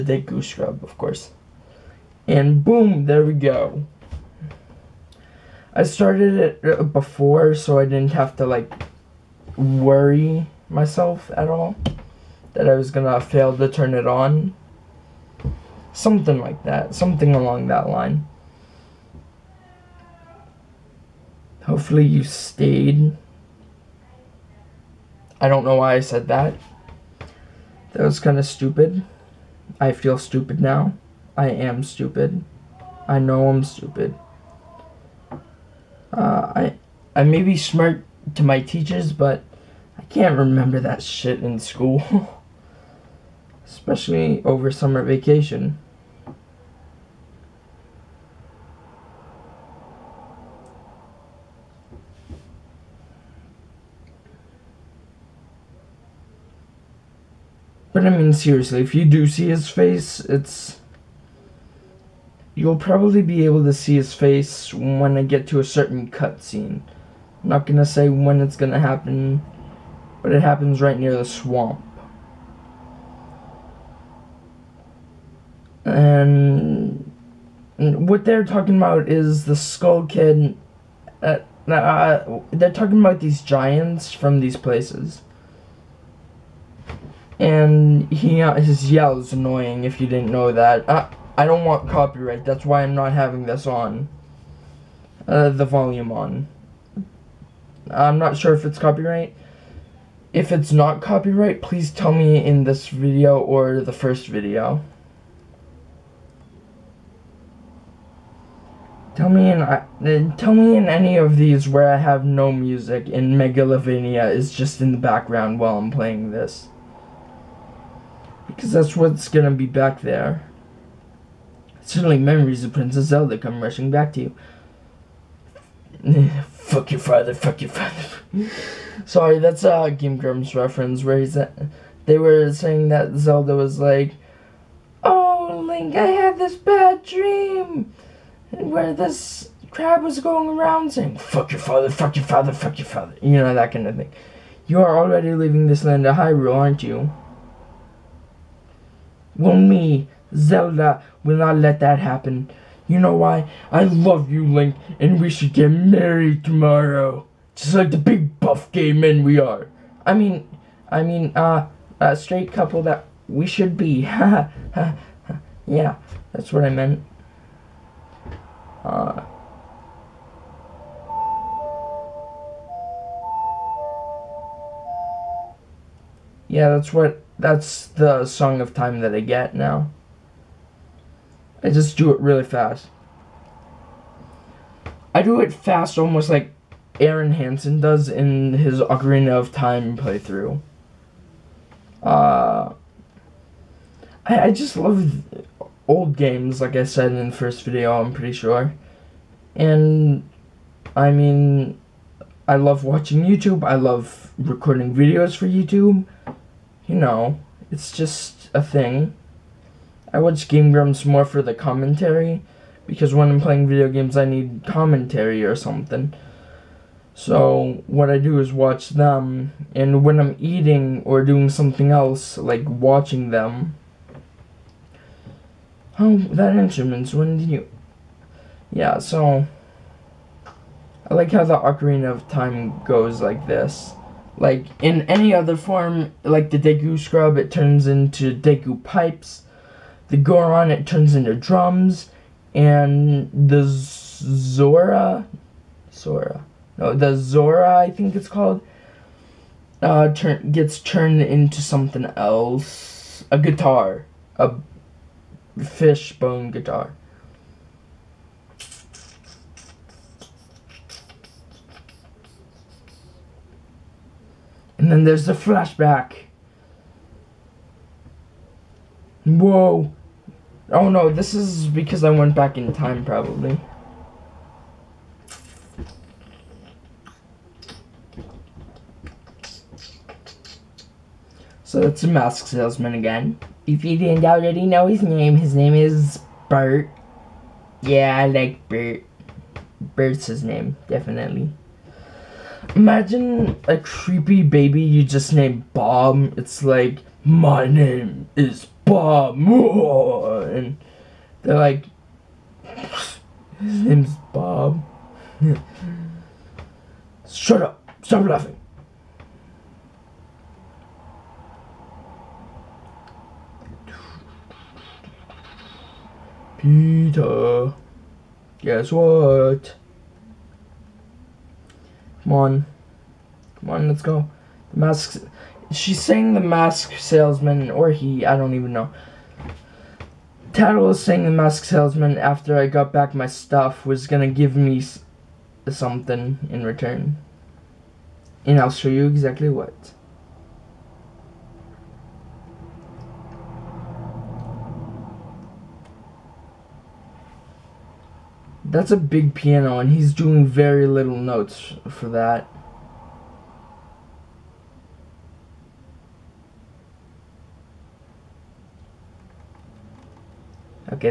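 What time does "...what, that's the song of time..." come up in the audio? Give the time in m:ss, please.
2:56.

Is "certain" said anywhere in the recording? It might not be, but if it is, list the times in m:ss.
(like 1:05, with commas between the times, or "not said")
1:05.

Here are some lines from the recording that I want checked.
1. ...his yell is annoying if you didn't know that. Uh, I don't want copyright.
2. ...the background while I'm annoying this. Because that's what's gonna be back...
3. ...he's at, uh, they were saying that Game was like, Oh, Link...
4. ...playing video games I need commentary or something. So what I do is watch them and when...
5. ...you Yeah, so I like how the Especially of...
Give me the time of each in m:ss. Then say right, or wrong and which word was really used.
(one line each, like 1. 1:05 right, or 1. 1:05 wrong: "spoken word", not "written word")
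1. 1:28 right
2. 1:54 wrong: "playing", not "annoying"
3. 2:11 wrong: "Zelda", not "Game"
4. 3:33 right
5. 3:47 wrong: "Ocarina", not "Especially".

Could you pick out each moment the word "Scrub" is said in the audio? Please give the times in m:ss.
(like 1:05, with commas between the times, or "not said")
0:00, 3:56.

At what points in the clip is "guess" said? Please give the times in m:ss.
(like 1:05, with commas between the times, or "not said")
5:18.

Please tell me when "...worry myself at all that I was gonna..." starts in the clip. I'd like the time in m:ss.
0:09.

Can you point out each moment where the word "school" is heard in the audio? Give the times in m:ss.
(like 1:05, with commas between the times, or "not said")
0:41.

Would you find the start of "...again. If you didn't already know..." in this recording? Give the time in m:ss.
4:42.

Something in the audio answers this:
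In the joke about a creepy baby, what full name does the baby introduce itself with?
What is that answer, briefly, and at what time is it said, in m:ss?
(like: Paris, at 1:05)
Bob Moore, at 4:58.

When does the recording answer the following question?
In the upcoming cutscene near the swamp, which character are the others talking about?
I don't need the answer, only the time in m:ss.
1:19.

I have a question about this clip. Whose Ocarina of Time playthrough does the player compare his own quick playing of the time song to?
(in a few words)
Arin Hanson.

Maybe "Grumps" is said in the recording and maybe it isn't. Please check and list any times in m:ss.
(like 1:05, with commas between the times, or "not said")
2:10, 3:30.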